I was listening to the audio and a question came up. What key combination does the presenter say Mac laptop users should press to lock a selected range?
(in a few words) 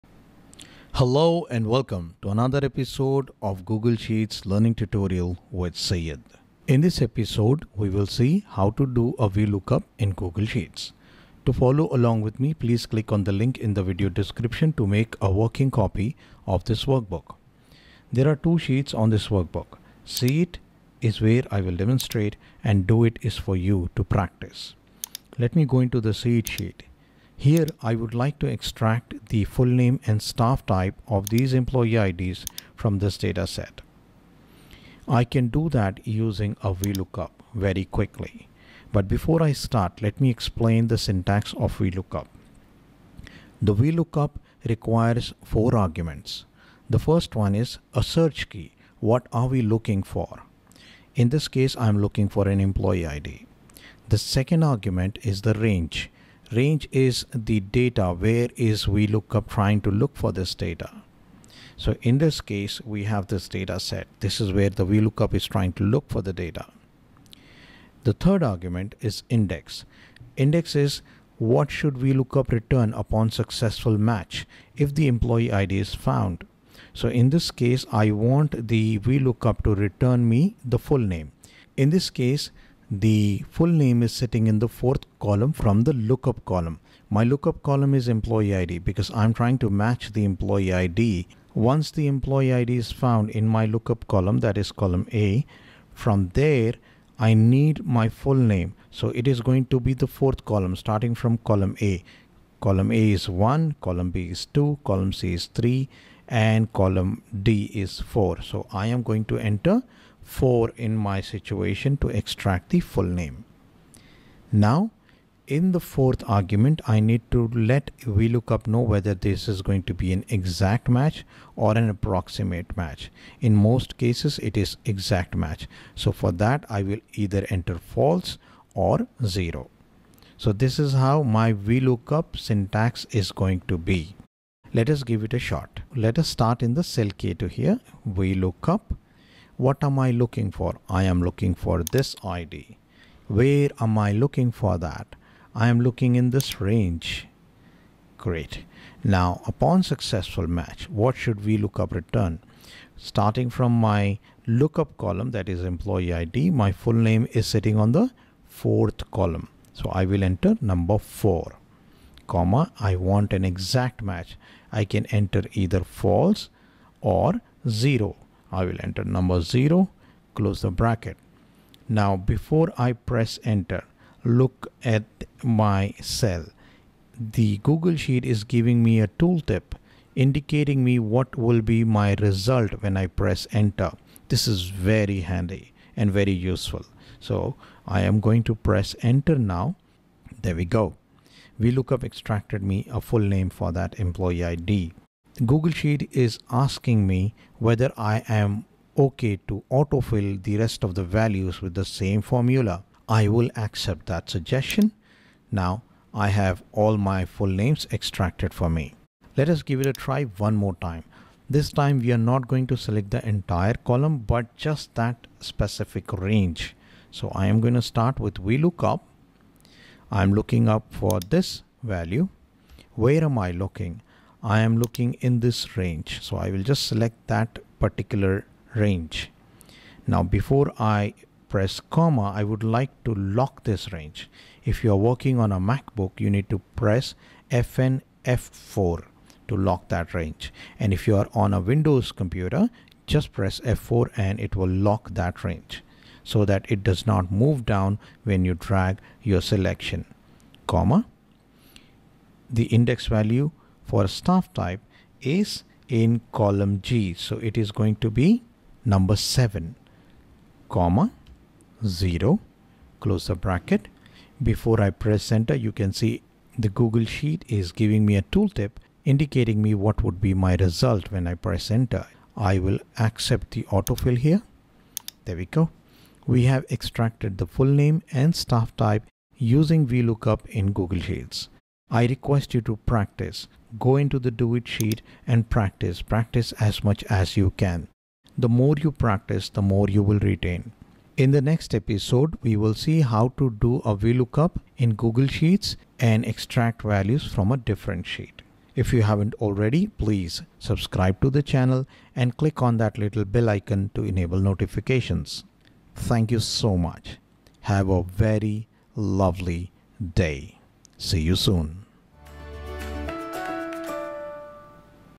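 Fn F4.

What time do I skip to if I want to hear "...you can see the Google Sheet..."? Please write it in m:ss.
4:25.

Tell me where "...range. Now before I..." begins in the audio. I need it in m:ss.
3:48.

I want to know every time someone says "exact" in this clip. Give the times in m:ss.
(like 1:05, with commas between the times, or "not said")
2:00, 2:04, 2:43.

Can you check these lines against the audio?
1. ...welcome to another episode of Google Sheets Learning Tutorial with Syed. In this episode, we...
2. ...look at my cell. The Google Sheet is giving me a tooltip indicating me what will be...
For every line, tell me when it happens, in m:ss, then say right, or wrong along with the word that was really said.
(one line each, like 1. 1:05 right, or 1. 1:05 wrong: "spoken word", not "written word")
1. 0:01 right
2. 2:54 right.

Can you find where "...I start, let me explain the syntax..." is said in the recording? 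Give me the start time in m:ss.
0:39.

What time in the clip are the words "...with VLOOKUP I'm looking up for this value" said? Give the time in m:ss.
3:38.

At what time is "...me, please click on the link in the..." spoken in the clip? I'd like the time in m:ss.
0:12.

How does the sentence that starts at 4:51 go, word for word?
In the next episode, we will see how to do a VLOOKUP in Google Sheets and extract values from a different sheet.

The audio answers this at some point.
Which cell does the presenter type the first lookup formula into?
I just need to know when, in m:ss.
2:17.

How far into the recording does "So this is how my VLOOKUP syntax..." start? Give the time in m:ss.
2:10.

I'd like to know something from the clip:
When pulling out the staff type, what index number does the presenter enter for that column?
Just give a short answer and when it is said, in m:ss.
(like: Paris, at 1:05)
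7, at 4:18.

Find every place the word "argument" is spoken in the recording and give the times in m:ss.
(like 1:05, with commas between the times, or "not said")
0:45, 0:54, 1:08, 1:56.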